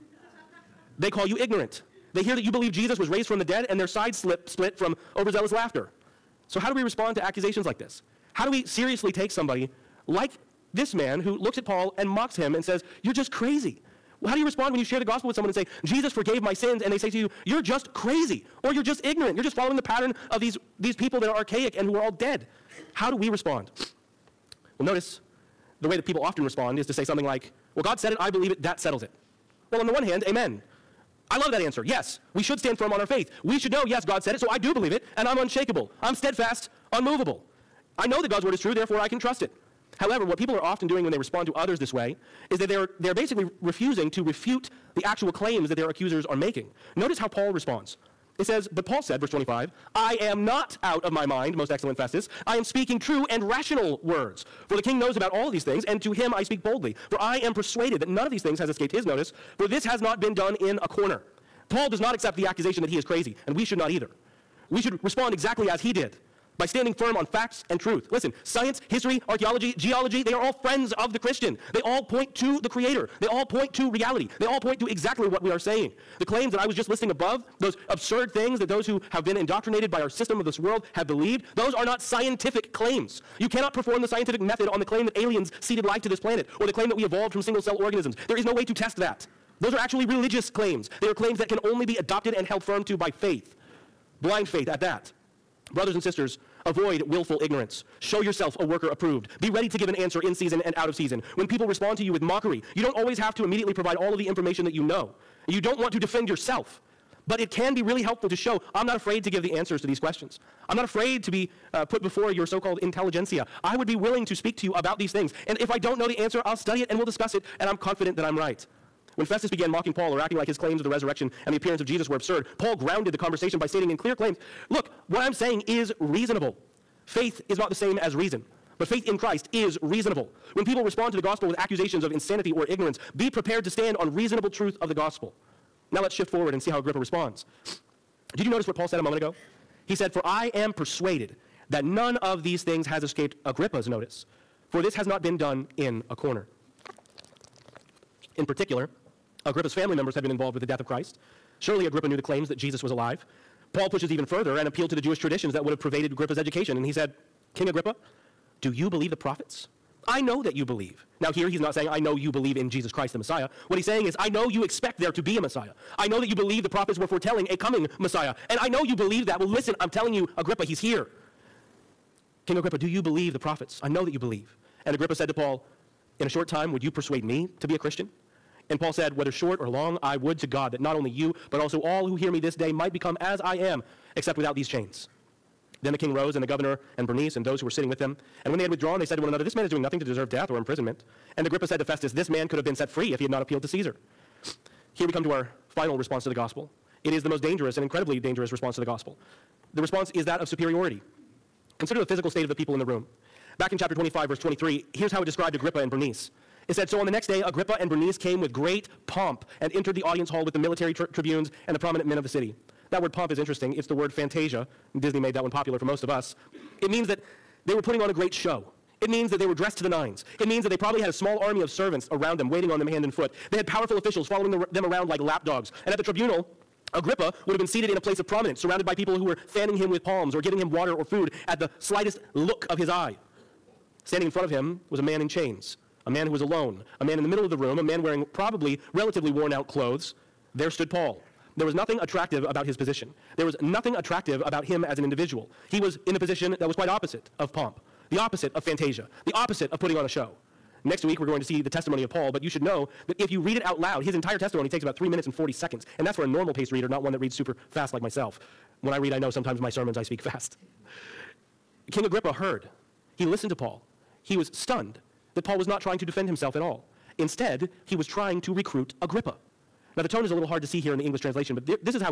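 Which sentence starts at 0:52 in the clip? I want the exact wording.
I am speaking true and rational words.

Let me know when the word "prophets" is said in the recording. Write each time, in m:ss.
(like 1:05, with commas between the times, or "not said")
2:39, 2:46, 2:53.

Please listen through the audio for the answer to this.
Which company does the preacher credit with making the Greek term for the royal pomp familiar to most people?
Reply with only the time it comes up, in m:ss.
3:34.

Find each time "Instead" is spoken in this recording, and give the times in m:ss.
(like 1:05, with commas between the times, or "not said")
4:27.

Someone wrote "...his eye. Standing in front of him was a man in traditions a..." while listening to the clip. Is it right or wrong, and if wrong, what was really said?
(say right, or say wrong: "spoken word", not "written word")
wrong: "chains", not "traditions".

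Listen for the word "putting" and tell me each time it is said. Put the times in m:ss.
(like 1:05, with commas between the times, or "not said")
3:37, 4:09.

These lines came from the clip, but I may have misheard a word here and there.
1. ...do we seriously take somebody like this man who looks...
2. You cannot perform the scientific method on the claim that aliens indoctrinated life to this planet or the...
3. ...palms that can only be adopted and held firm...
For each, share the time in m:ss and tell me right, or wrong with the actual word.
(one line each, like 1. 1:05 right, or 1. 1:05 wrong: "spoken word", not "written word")
1. 0:08 right
2. 1:23 wrong: "seeded", not "indoctrinated"
3. 1:31 wrong: "claims", not "palms".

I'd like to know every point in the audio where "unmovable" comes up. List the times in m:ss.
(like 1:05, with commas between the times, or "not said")
0:36.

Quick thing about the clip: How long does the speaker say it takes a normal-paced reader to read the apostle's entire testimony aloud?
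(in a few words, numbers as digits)
3 minutes and 40 seconds.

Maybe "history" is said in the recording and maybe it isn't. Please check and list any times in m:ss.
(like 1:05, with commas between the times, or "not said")
1:08.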